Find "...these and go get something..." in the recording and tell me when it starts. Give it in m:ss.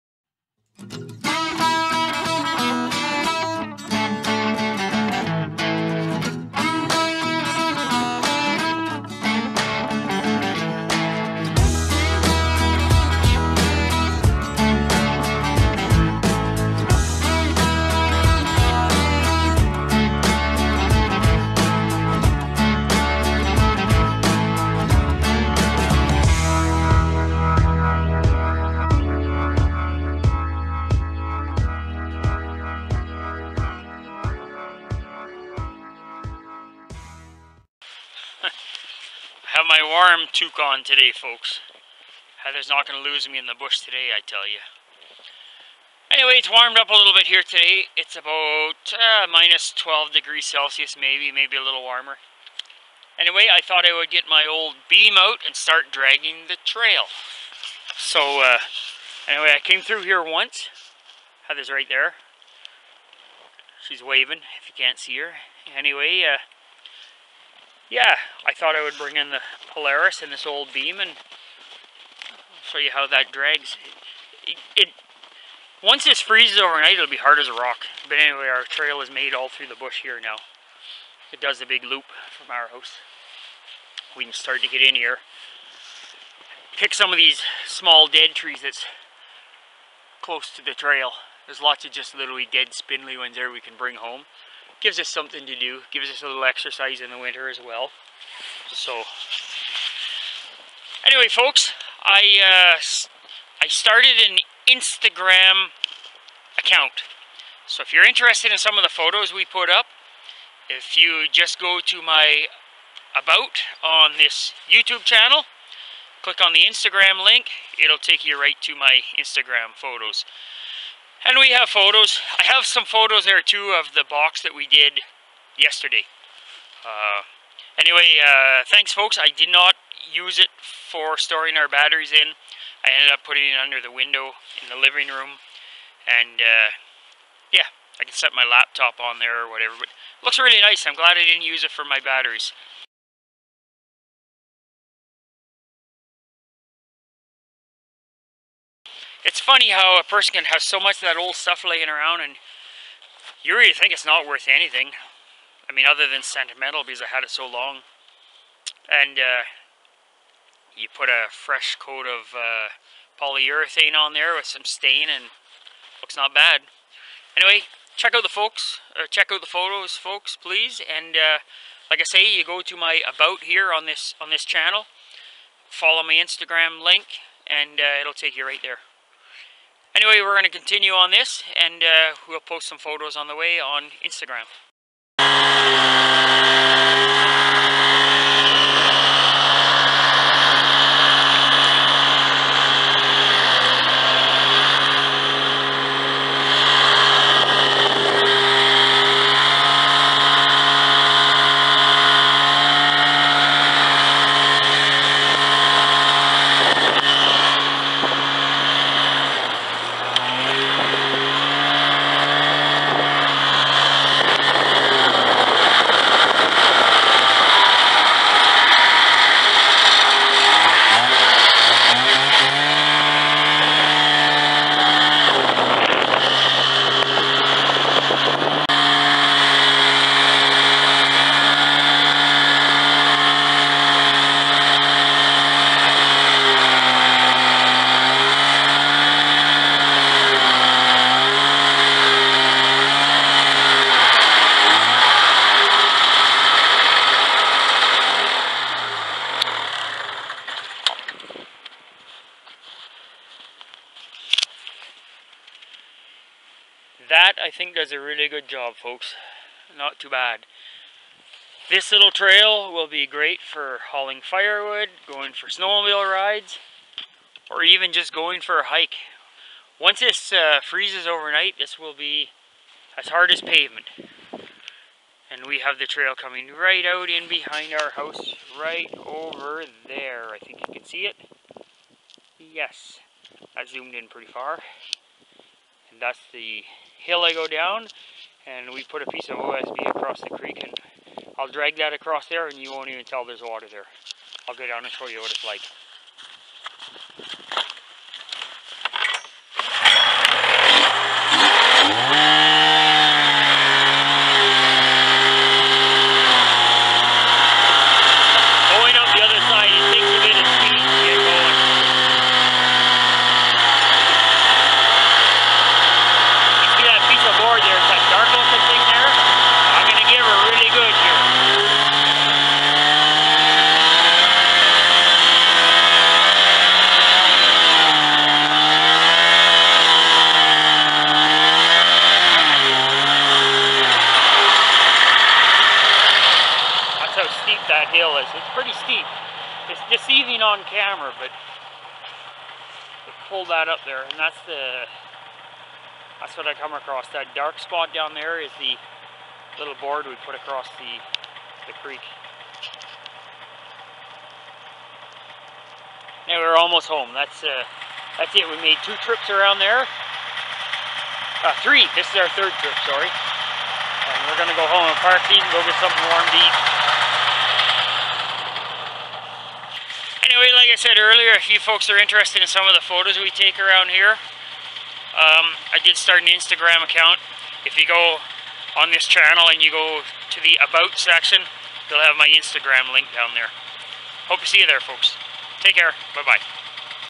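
6:05.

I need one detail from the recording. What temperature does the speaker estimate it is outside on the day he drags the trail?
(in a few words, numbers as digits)
-12°C.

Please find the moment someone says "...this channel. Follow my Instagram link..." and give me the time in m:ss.
2:54.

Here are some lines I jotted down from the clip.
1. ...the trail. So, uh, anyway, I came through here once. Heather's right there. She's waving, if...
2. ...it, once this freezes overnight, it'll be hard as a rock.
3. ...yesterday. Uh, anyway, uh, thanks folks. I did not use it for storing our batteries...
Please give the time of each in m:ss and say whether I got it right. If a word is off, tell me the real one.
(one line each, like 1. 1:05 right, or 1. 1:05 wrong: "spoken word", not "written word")
1. 0:56 right
2. 1:14 right
3. 2:05 right.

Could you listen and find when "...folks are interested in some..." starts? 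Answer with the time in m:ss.
6:11.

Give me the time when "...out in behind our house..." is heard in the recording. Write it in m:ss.
4:36.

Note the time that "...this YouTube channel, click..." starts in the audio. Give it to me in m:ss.
1:54.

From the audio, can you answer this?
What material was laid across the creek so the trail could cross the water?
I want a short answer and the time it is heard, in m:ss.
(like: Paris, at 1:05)
OSB, at 4:49.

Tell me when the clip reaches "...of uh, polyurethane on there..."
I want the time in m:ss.
2:42.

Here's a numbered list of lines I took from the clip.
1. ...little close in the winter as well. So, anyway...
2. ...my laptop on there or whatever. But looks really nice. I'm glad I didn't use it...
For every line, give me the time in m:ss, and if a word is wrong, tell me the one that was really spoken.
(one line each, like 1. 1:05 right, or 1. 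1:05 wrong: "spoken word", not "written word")
1. 1:36 wrong: "exercise", not "close"
2. 2:18 right.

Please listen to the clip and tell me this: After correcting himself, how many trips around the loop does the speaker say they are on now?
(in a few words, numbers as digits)
3.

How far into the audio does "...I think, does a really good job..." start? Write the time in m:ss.
4:17.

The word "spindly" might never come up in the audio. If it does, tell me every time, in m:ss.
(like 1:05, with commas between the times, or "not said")
1:32.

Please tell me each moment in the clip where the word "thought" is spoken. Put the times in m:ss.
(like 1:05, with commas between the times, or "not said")
0:53, 1:08.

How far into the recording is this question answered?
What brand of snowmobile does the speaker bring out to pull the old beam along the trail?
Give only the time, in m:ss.
1:09.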